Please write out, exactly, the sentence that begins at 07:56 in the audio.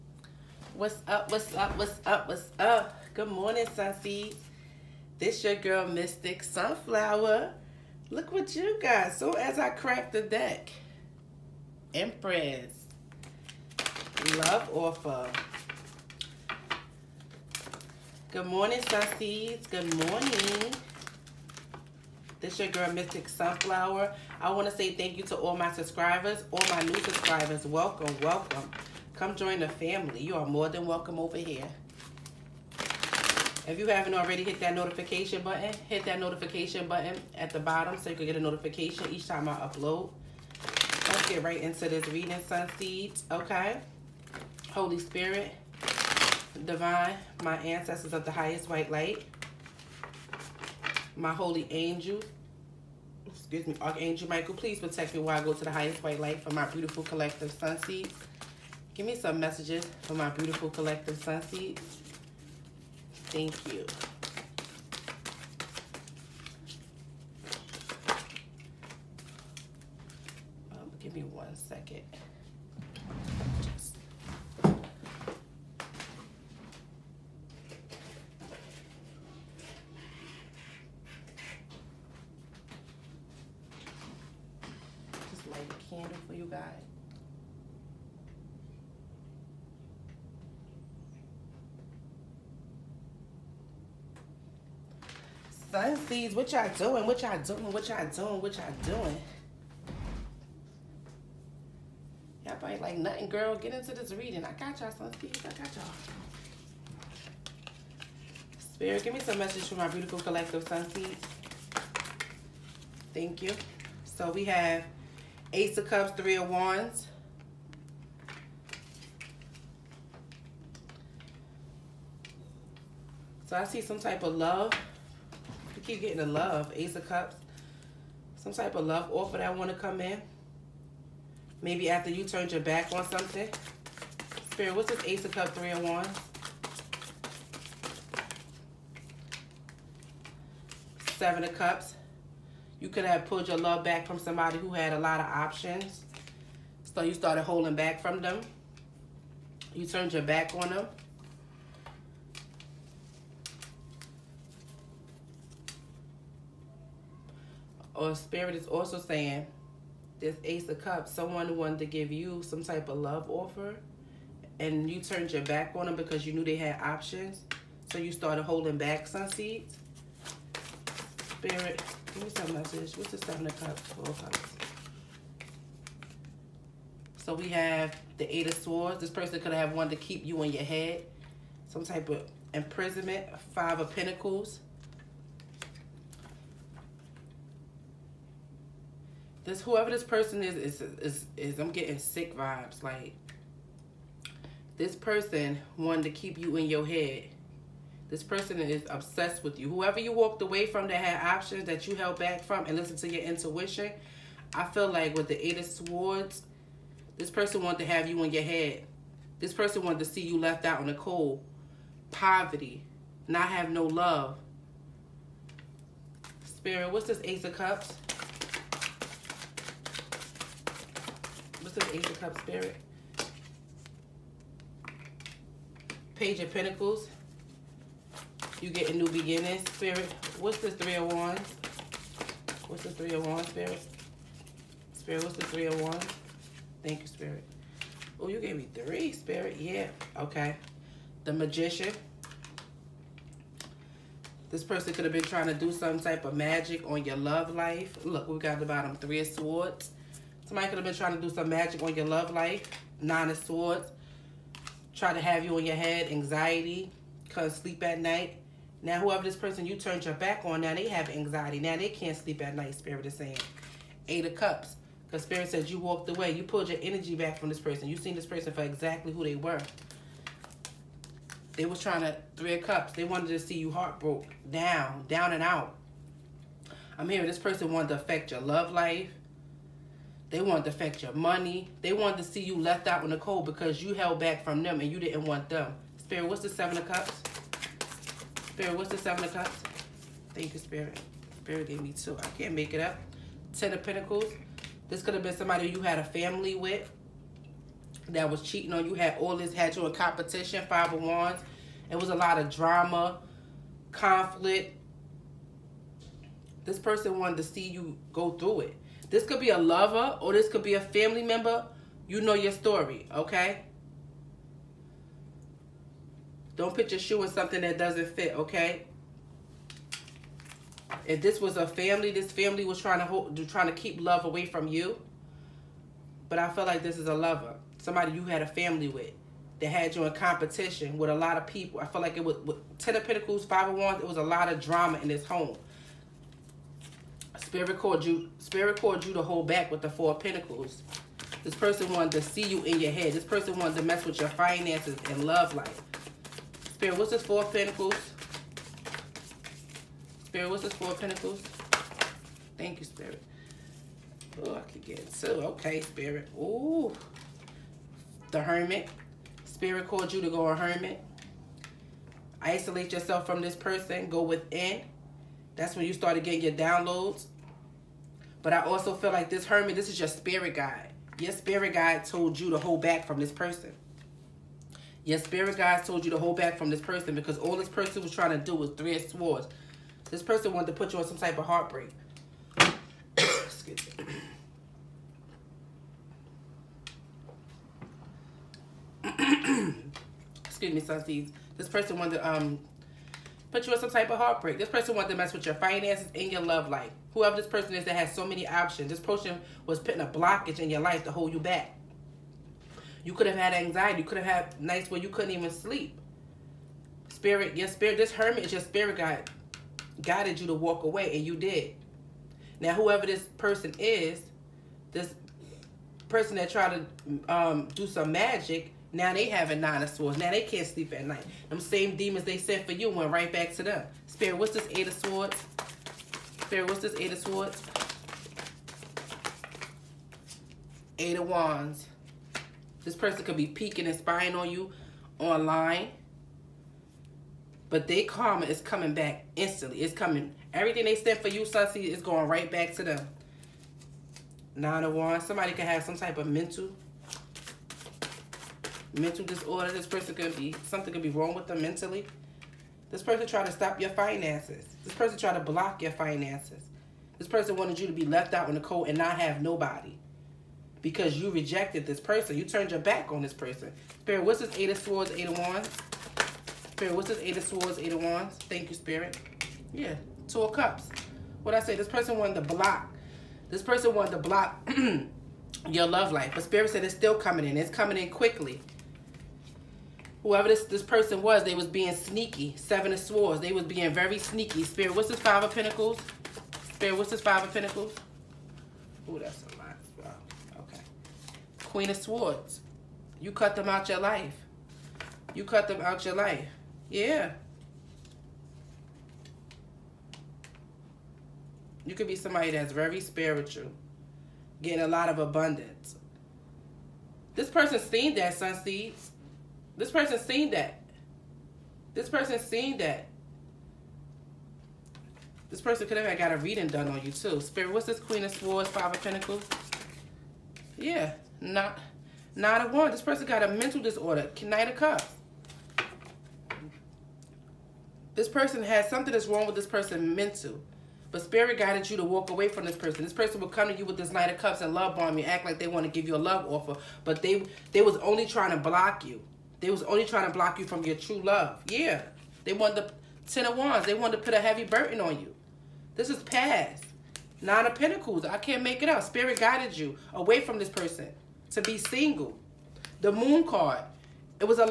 But Spirit said it's still coming in.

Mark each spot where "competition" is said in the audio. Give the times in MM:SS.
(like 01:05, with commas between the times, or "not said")
04:59, 05:30.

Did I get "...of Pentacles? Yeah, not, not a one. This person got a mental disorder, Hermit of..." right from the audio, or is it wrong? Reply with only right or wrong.
wrong.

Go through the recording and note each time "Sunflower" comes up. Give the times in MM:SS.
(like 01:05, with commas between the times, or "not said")
00:06, 00:23.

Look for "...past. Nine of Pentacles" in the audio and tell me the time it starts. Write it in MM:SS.
09:06.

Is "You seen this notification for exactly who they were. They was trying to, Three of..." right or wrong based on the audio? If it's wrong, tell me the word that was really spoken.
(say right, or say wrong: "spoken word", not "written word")
wrong: "person", not "notification".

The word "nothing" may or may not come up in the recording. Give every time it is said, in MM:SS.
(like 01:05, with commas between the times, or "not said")
01:42.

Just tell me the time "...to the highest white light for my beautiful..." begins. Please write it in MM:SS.
00:55.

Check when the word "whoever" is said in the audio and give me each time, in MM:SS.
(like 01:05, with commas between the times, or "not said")
03:09, 03:19, 04:18, 06:37, 06:52, 08:00.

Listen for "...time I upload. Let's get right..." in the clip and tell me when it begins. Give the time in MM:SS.
00:39.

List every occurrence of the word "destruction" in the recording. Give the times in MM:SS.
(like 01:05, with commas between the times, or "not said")
not said.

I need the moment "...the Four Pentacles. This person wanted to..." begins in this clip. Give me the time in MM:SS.
05:39.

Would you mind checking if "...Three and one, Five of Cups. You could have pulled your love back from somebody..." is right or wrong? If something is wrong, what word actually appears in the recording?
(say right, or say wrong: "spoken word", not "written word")
wrong: "Seven", not "Five".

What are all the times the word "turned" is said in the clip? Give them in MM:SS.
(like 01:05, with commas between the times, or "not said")
02:12, 02:29, 02:44, 04:19, 07:42.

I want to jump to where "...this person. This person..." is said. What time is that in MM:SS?
08:52.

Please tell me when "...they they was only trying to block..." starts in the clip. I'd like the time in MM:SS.
08:57.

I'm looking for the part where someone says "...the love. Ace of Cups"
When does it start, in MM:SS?
02:06.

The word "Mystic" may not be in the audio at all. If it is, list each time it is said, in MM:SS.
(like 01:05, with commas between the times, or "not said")
00:05, 00:22.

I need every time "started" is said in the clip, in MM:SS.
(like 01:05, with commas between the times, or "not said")
02:27, 02:48, 06:05.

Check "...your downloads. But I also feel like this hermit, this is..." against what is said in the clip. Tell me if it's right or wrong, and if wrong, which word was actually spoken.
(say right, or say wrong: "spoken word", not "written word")
right.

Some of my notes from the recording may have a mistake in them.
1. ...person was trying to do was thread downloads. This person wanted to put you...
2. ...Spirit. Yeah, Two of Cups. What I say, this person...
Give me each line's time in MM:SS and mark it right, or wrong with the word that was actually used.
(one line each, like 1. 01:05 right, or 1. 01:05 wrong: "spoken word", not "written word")
1. 06:17 wrong: "swords", not "downloads"
2. 07:48 right.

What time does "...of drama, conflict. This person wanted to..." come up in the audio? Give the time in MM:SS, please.
05:02.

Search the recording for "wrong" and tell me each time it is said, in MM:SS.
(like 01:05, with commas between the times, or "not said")
07:31, 08:49.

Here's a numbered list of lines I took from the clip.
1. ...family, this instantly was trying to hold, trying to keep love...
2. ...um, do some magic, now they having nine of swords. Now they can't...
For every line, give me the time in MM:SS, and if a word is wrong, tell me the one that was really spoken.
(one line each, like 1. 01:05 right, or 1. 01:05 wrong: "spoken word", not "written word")
1. 05:21 wrong: "family", not "instantly"
2. 06:57 right.